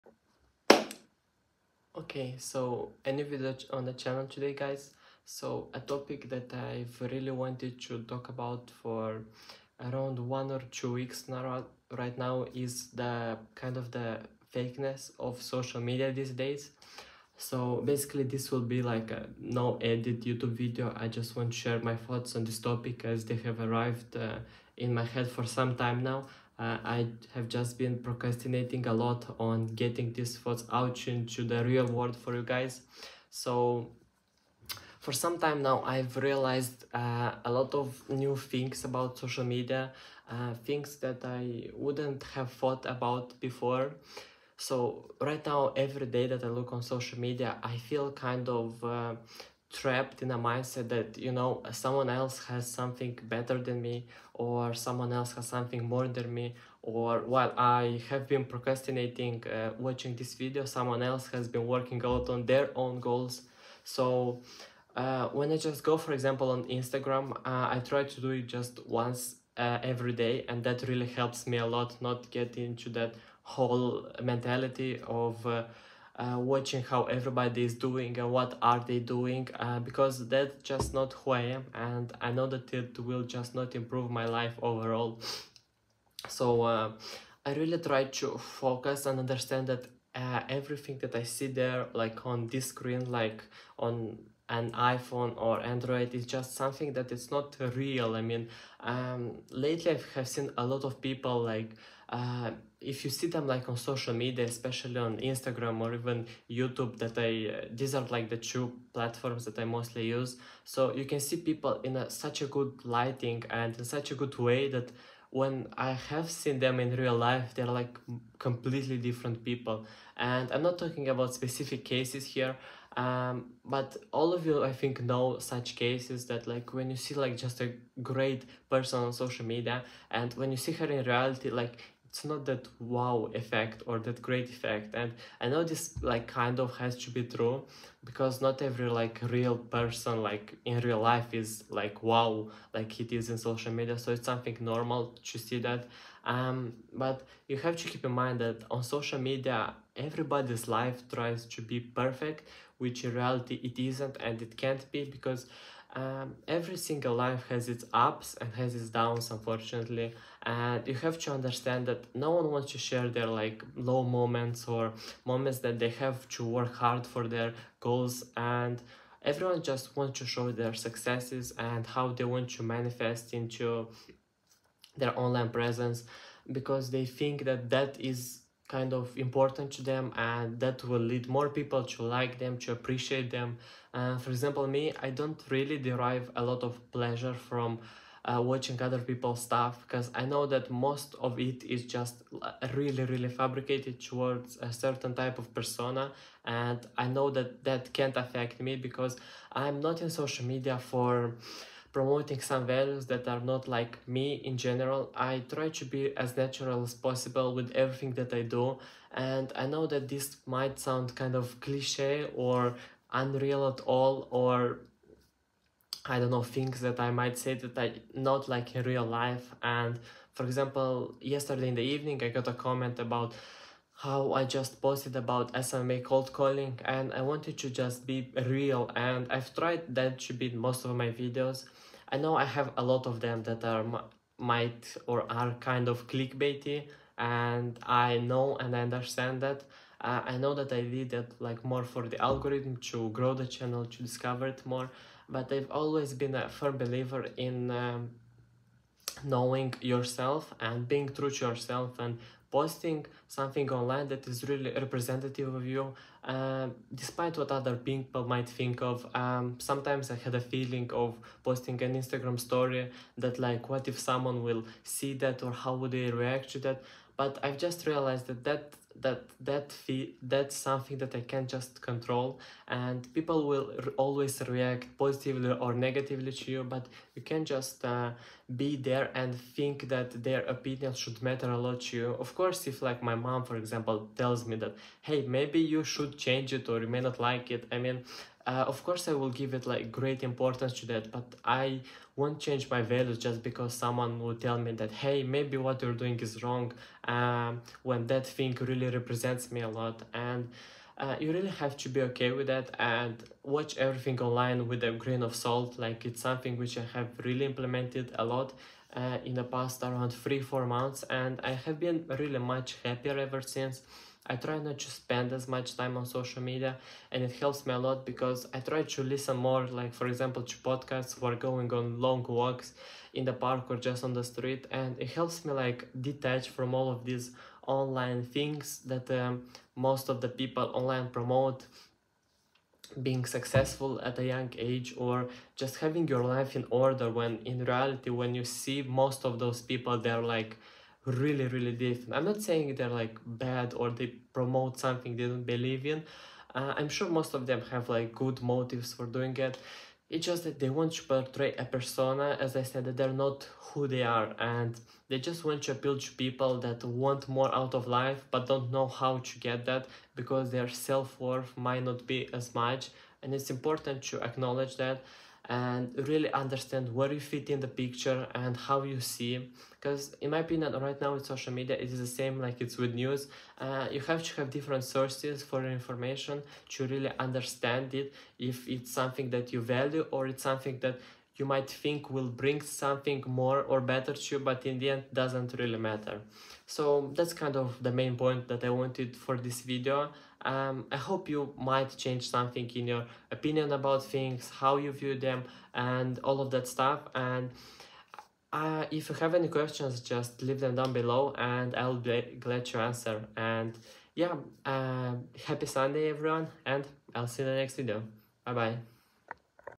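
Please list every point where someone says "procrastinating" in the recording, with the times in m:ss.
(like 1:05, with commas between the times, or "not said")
0:28, 0:58.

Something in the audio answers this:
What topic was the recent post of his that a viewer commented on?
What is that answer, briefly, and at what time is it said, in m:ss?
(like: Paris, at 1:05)
SMA cold calling, at 3:45.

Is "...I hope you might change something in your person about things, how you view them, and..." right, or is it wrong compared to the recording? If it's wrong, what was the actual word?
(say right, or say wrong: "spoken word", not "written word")
wrong: "opinion", not "person".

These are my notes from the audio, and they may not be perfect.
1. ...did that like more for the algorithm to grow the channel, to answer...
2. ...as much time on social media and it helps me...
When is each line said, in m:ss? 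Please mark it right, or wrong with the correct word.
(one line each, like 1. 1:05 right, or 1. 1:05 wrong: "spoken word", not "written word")
1. 4:00 wrong: "discover", not "answer"
2. 5:15 right.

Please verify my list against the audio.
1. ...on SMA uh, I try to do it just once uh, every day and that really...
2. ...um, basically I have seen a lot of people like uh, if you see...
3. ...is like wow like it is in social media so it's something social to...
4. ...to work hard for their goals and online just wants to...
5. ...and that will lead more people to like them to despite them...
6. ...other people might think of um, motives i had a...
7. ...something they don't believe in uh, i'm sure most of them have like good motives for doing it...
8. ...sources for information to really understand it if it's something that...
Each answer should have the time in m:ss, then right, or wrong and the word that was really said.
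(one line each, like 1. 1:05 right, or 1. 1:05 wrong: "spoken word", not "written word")
1. 1:06 wrong: "Instagram", not "SMA"
2. 1:38 wrong: "lately", not "basically"
3. 2:21 wrong: "normal", not "social"
4. 2:46 wrong: "everyone", not "online"
5. 3:00 wrong: "appreciate", not "despite"
6. 4:17 wrong: "sometimes", not "motives"
7. 5:44 right
8. 6:14 right.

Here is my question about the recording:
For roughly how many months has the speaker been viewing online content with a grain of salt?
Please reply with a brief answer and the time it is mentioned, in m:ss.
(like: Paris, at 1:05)
3-4 months, at 5:10.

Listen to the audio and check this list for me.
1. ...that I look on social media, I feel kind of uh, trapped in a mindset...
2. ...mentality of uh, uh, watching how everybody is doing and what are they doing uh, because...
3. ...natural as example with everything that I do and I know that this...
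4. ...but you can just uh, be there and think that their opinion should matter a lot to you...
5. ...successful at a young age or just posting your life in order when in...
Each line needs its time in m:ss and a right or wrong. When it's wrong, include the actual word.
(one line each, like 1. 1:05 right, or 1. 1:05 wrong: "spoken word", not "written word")
1. 0:46 right
2. 1:14 right
3. 3:26 wrong: "possible", not "example"
4. 4:36 right
5. 5:33 wrong: "having", not "posting".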